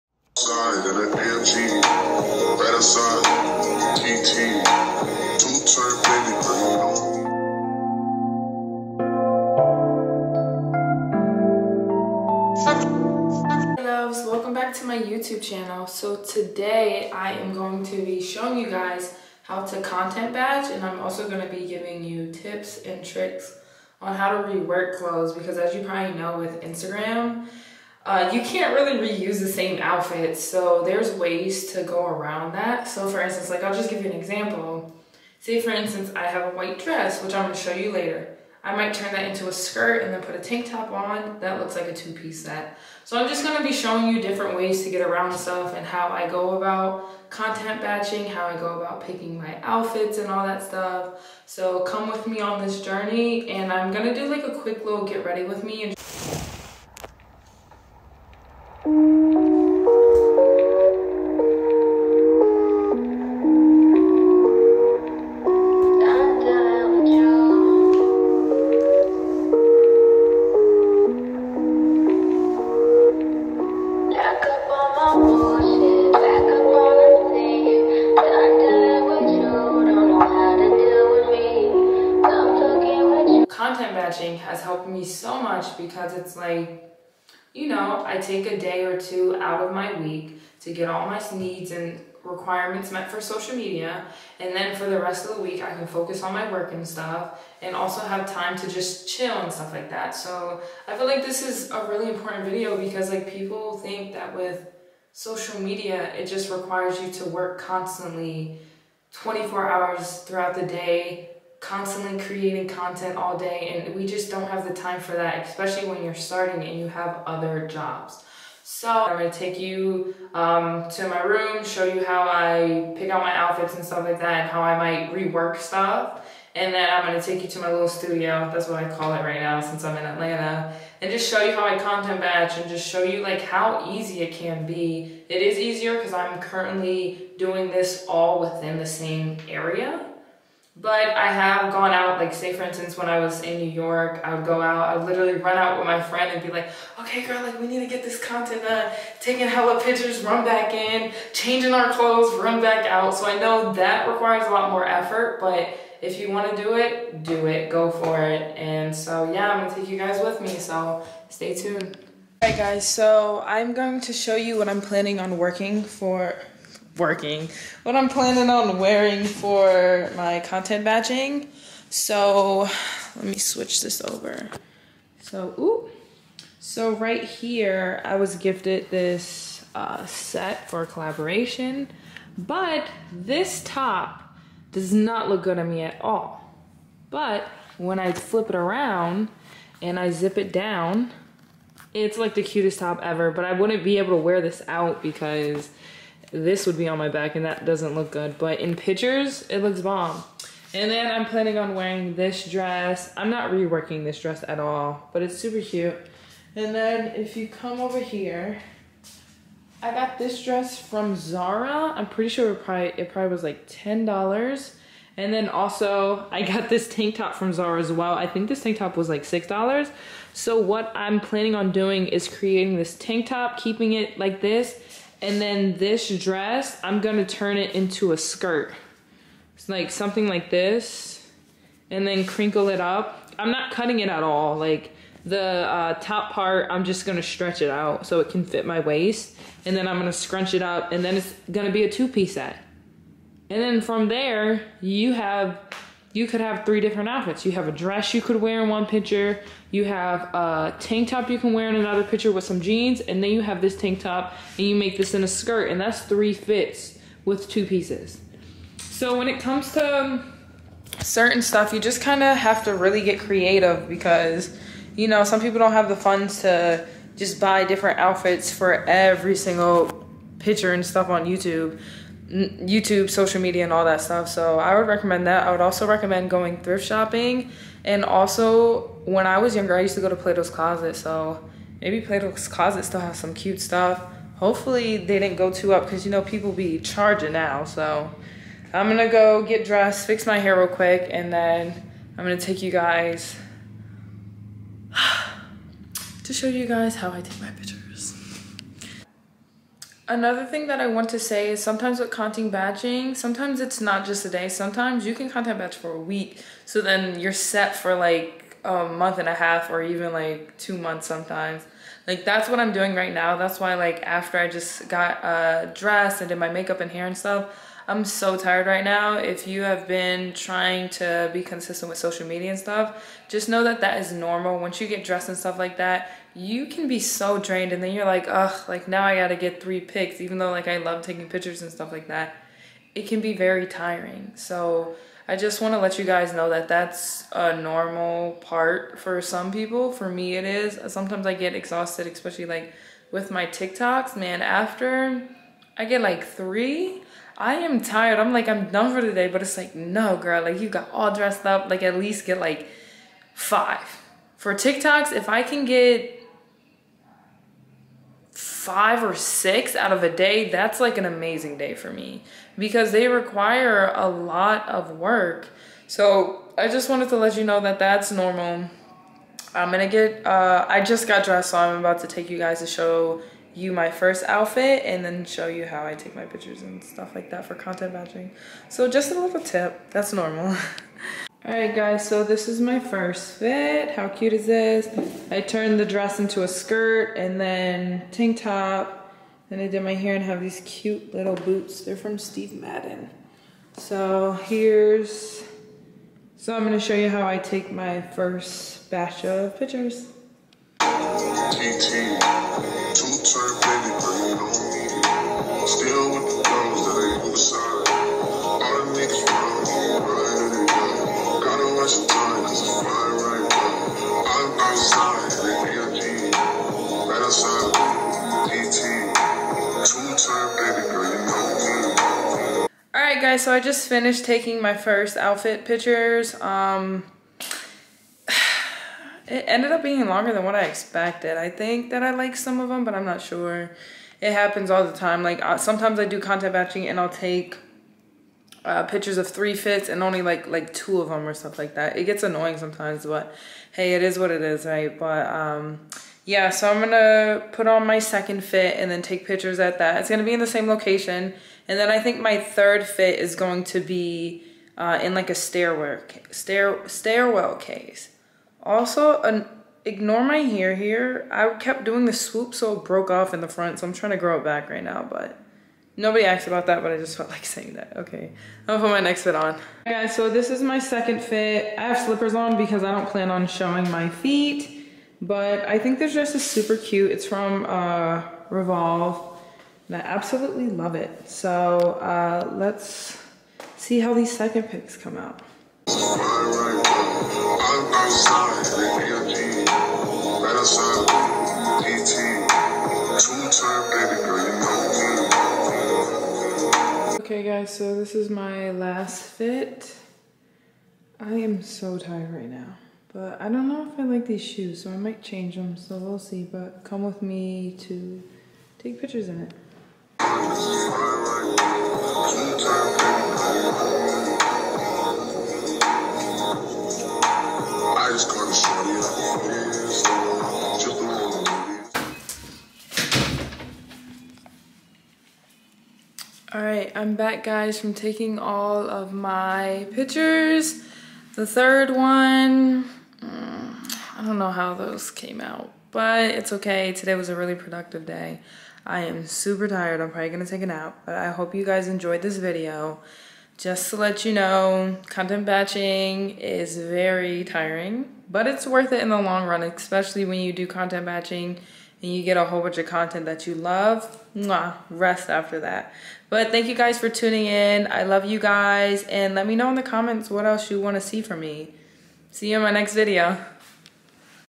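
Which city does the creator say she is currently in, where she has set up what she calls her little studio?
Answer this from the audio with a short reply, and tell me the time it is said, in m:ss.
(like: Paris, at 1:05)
Atlanta, at 2:10.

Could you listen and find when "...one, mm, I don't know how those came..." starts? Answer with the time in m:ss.
8:51.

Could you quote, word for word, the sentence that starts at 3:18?
But in pictures, it looks bomb.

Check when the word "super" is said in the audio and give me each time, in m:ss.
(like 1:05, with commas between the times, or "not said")
3:25, 7:56, 8:59.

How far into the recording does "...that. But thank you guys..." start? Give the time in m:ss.
9:15.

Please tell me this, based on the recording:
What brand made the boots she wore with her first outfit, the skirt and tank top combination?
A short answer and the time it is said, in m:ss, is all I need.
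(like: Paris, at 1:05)
Steve Madden, at 6:32.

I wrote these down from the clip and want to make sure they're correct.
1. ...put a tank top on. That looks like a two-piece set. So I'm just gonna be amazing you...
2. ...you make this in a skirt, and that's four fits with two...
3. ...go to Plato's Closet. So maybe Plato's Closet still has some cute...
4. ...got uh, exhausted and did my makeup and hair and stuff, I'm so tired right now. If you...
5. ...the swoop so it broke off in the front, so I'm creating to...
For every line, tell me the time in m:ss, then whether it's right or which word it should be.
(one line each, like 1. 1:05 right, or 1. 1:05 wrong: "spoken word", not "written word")
1. 0:40 wrong: "showing", not "amazing"
2. 4:14 wrong: "three", not "four"
3. 4:40 right
4. 5:14 wrong: "dressed", not "exhausted"
5. 7:42 wrong: "trying", not "creating".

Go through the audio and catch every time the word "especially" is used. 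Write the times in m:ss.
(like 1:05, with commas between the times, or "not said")
1:55, 5:42, 9:09.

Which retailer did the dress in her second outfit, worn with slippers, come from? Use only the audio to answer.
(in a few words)
Revolve.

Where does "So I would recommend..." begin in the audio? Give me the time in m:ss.
4:34.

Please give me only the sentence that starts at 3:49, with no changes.
It's like something like this and then crinkle it up.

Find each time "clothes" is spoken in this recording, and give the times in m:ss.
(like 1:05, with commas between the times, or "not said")
0:24, 2:31.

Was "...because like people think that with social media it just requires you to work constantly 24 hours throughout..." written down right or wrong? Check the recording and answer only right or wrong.
right.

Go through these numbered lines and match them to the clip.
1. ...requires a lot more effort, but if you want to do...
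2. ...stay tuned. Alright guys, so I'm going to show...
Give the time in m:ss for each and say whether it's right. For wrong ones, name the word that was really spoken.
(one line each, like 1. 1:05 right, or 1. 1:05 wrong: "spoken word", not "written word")
1. 2:34 right
2. 2:41 right.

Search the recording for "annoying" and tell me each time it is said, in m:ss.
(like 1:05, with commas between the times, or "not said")
7:22.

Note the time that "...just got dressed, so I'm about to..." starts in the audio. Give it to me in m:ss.
6:10.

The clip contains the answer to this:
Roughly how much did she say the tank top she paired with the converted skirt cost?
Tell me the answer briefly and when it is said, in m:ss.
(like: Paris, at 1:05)
$6, at 3:39.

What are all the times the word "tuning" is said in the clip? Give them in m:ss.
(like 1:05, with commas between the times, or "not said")
9:17.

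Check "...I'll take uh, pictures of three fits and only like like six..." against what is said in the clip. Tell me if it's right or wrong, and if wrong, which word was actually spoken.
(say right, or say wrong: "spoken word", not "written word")
wrong: "two", not "six".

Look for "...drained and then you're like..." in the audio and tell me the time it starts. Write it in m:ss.
5:27.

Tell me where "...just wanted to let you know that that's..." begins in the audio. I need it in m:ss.
6:06.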